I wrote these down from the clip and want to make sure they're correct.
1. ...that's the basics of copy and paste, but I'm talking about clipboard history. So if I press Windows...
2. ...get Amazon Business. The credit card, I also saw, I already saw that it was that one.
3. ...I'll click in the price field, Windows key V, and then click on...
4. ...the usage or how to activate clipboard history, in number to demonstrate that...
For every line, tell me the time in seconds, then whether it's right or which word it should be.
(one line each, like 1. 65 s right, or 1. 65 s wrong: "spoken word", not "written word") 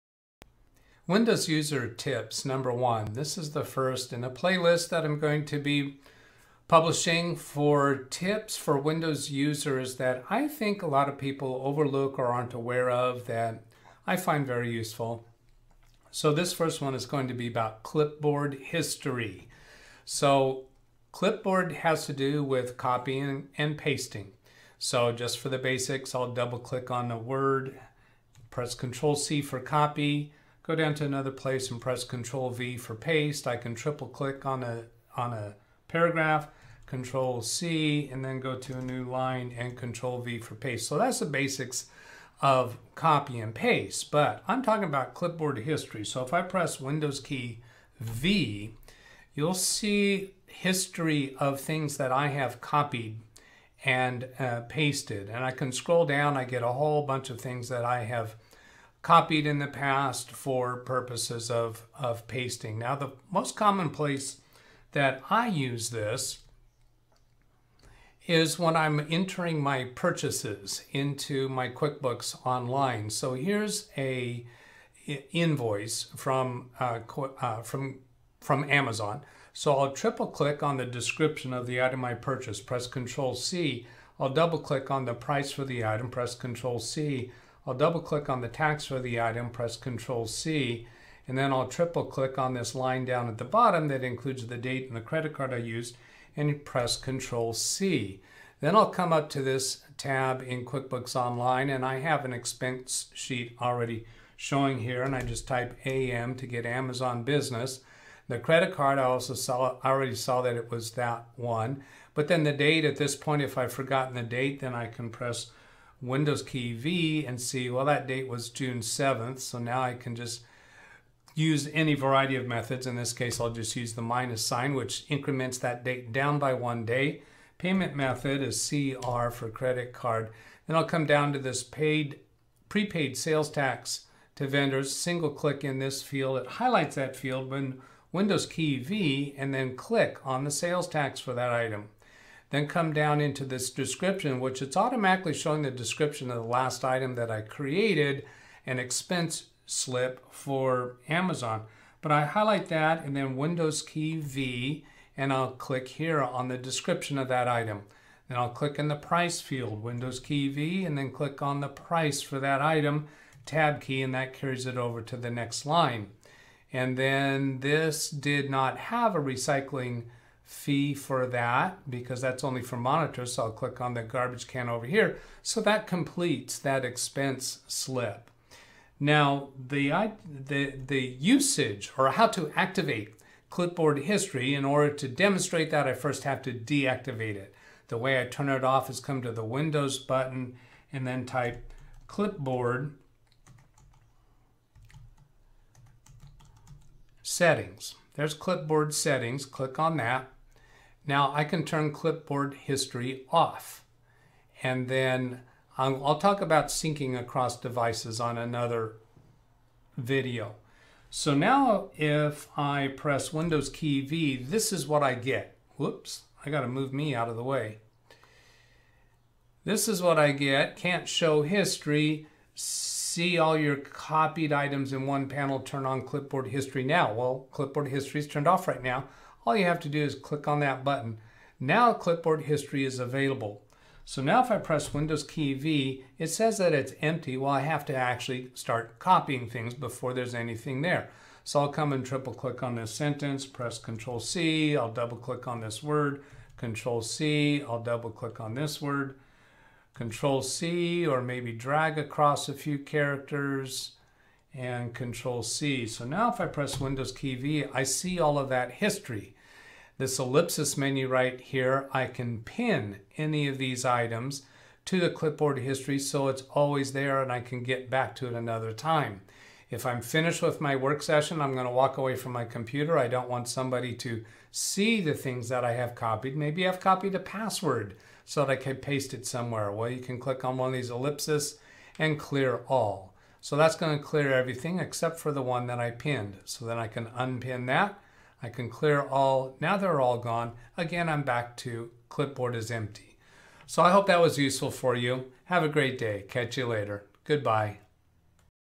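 1. 40 s right
2. 106 s right
3. 158 s right
4. 180 s wrong: "order", not "number".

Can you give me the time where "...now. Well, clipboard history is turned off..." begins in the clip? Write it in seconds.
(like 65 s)
226 s.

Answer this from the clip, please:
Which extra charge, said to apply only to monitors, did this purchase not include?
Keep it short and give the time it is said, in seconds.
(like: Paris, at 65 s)
recycling fee, at 169 s.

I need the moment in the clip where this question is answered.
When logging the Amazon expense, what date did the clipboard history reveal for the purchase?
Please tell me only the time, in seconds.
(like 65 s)
118 s.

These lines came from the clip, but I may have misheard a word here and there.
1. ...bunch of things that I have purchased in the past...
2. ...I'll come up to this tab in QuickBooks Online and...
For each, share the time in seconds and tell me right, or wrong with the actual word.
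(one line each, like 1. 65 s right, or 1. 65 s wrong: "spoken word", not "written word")
1. 57 s wrong: "copied", not "purchased"
2. 98 s right.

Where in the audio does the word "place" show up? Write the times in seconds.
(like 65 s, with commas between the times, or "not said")
31 s, 63 s.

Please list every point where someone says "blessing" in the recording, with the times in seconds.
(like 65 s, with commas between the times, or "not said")
not said.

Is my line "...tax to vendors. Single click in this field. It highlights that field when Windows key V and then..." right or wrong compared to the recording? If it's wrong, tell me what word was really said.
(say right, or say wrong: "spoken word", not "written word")
right.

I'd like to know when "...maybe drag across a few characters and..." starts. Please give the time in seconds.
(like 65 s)
251 s.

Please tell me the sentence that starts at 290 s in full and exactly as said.
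Again, I'm back to clipboard is empty.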